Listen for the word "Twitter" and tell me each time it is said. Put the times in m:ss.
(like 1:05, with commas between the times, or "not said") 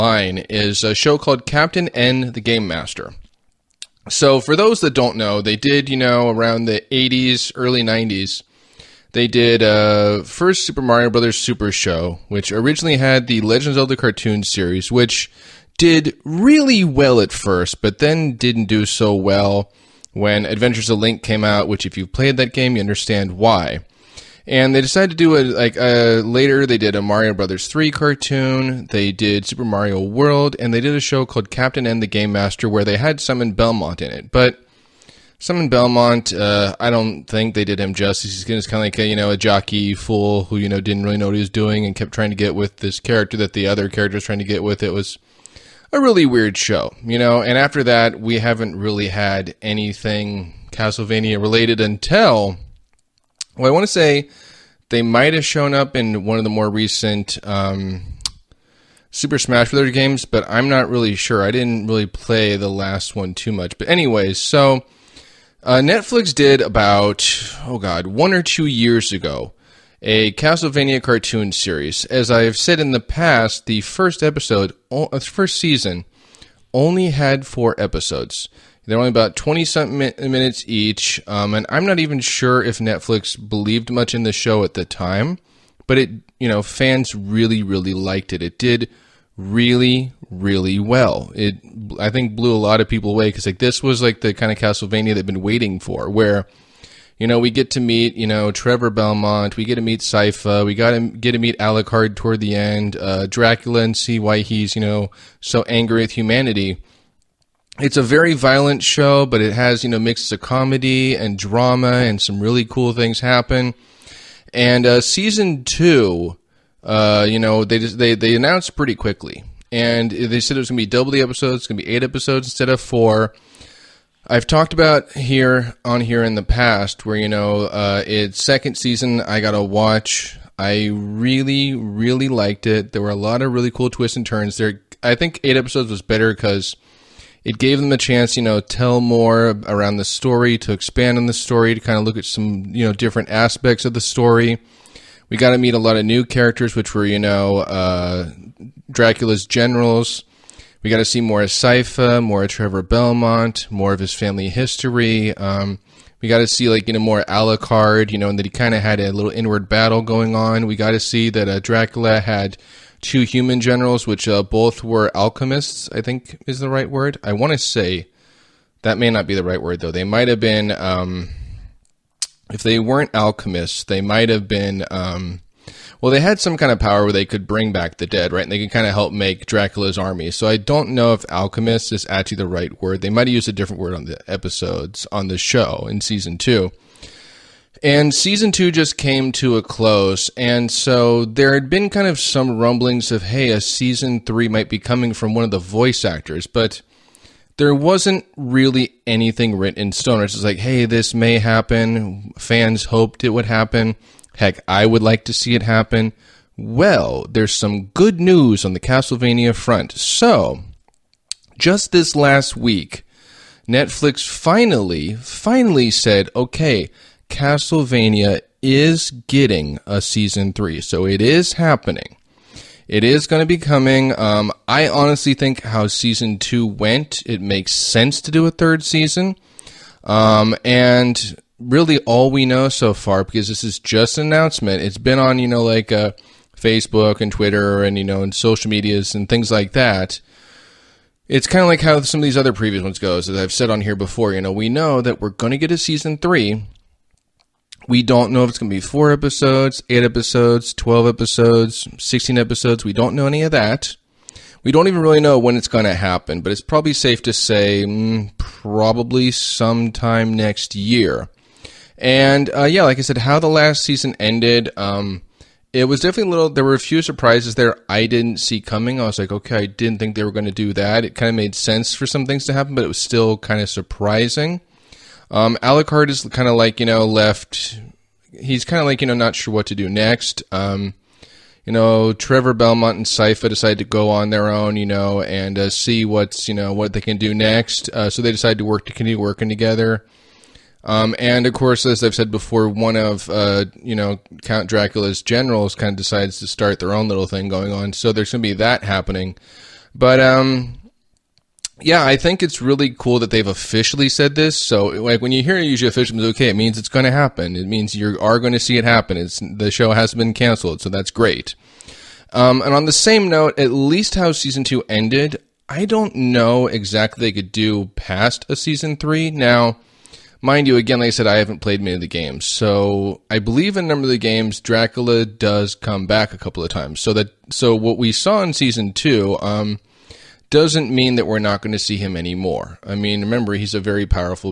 3:57.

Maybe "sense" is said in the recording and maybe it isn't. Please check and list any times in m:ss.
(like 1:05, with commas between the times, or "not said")
3:47, 4:31.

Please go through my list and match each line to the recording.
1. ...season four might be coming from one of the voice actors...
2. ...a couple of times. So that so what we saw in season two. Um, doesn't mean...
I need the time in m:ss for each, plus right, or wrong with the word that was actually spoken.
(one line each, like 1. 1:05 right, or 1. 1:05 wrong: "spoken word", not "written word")
1. 3:13 wrong: "three", not "four"
2. 5:26 right.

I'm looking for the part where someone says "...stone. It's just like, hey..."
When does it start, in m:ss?
3:19.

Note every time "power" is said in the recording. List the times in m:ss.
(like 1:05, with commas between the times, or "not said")
2:56.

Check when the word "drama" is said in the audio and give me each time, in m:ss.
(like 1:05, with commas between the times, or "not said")
1:51.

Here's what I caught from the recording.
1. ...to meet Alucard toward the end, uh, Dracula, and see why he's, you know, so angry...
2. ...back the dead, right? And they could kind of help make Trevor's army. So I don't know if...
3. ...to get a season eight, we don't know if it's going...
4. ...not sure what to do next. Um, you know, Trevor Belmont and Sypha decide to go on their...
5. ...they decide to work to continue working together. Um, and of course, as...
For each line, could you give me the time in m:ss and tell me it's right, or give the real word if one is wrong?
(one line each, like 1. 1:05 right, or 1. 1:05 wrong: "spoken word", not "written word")
1. 1:41 right
2. 2:57 wrong: "Dracula", not "Trevor"
3. 4:05 wrong: "three", not "eight"
4. 4:39 right
5. 4:48 right.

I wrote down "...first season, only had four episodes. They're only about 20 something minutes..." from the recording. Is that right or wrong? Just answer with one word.
right.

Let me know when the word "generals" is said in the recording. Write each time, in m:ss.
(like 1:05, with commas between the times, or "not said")
2:29, 2:43, 4:55.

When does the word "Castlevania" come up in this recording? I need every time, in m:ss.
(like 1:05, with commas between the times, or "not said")
0:50, 1:10, 1:34, 3:28, 3:37.